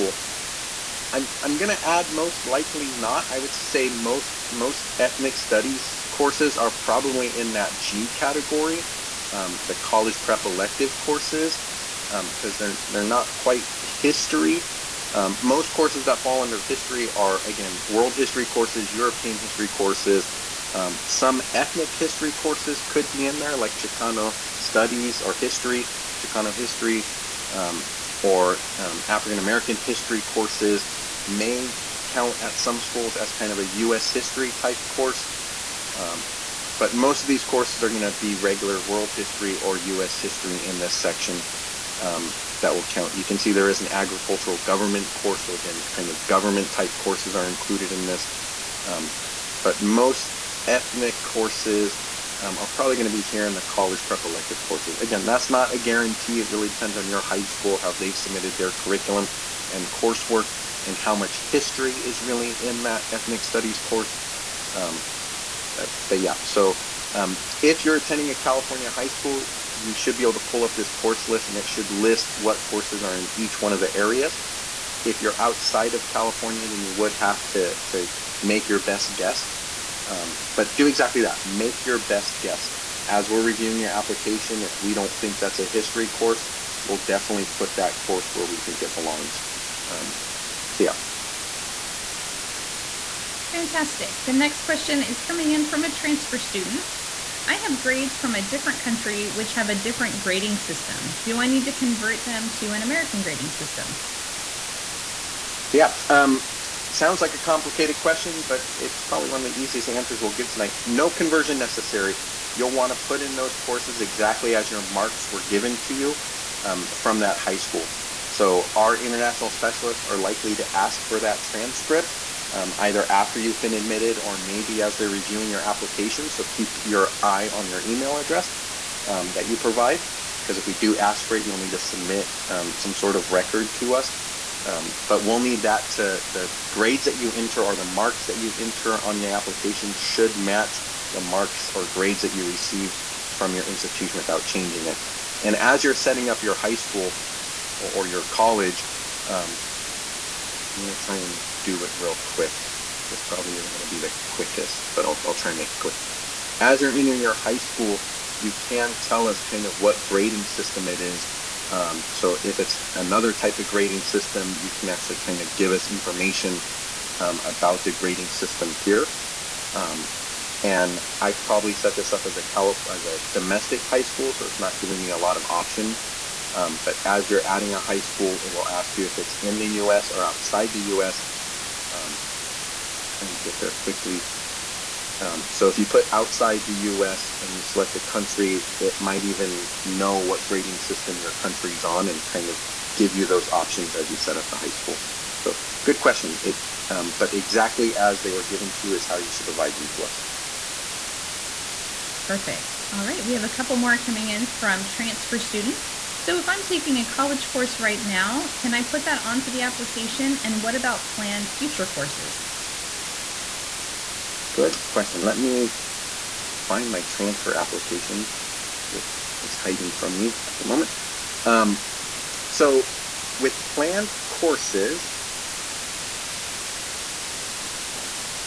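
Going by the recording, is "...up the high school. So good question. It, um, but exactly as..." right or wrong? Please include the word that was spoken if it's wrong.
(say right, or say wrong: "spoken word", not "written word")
right.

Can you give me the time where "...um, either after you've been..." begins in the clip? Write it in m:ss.
2:02.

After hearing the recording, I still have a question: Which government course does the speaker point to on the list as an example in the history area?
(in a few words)
agricultural government.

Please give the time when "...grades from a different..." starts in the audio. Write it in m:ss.
1:37.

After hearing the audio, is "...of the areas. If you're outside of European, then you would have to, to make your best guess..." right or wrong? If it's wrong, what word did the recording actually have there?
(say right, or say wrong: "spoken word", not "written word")
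wrong: "California", not "European".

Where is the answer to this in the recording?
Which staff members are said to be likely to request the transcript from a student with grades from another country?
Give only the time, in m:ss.
1:59.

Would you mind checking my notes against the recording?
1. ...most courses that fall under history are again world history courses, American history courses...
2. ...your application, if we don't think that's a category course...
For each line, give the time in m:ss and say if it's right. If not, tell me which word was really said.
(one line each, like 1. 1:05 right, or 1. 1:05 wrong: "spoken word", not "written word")
1. 0:15 wrong: "European", not "American"
2. 1:23 wrong: "history", not "category".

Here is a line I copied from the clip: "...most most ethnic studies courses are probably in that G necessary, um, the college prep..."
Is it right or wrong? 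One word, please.
wrong.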